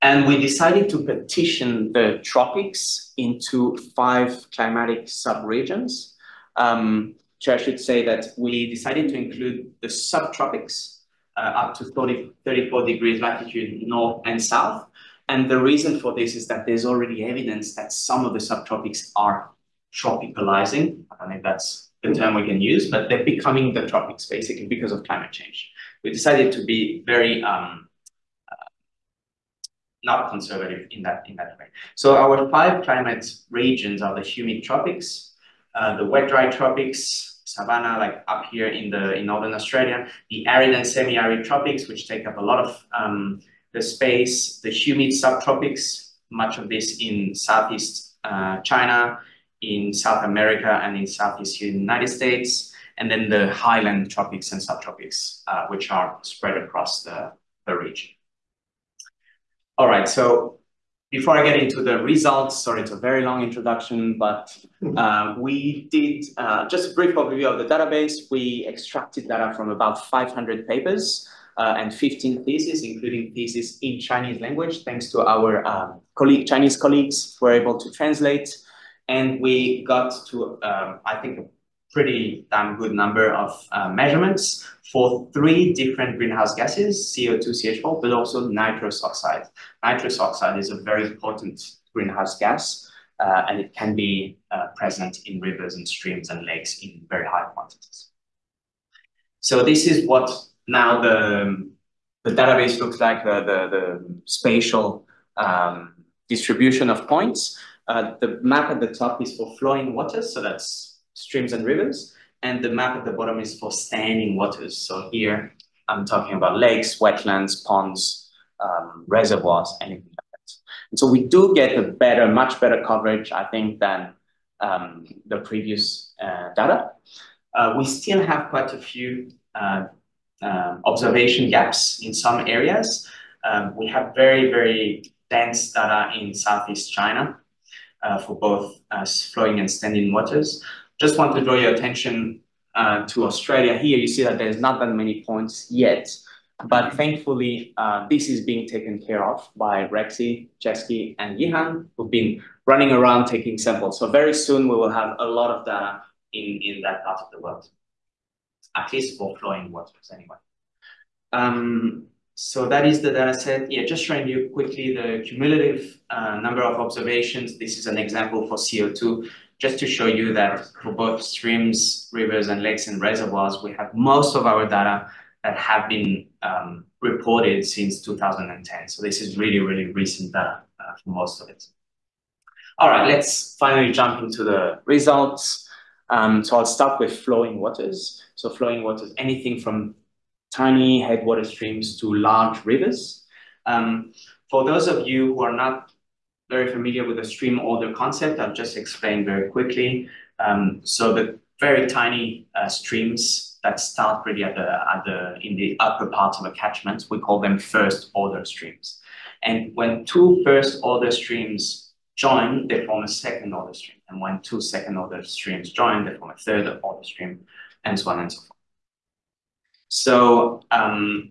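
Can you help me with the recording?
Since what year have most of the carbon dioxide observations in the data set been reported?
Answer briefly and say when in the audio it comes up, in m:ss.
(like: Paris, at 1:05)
2010, at 2:58.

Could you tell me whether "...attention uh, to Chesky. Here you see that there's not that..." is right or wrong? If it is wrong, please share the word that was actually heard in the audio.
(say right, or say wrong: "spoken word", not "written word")
wrong: "Australia", not "Chesky".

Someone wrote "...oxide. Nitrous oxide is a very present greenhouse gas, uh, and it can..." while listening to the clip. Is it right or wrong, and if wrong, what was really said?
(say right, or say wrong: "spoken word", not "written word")
wrong: "important", not "present".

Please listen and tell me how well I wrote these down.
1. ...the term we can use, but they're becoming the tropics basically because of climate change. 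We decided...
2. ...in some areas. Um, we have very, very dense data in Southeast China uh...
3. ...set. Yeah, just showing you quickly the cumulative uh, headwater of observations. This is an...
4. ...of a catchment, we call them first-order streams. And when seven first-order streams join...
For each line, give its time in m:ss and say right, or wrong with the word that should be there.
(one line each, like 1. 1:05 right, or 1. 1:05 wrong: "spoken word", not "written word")
1. 0:22 right
2. 2:12 right
3. 2:43 wrong: "number", not "headwater"
4. 3:26 wrong: "two", not "seven".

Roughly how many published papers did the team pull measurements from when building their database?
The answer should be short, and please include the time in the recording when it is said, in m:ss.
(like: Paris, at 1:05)
500, at 1:09.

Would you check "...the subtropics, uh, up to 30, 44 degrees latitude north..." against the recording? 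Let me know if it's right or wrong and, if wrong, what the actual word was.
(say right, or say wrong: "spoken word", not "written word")
wrong: "34", not "44".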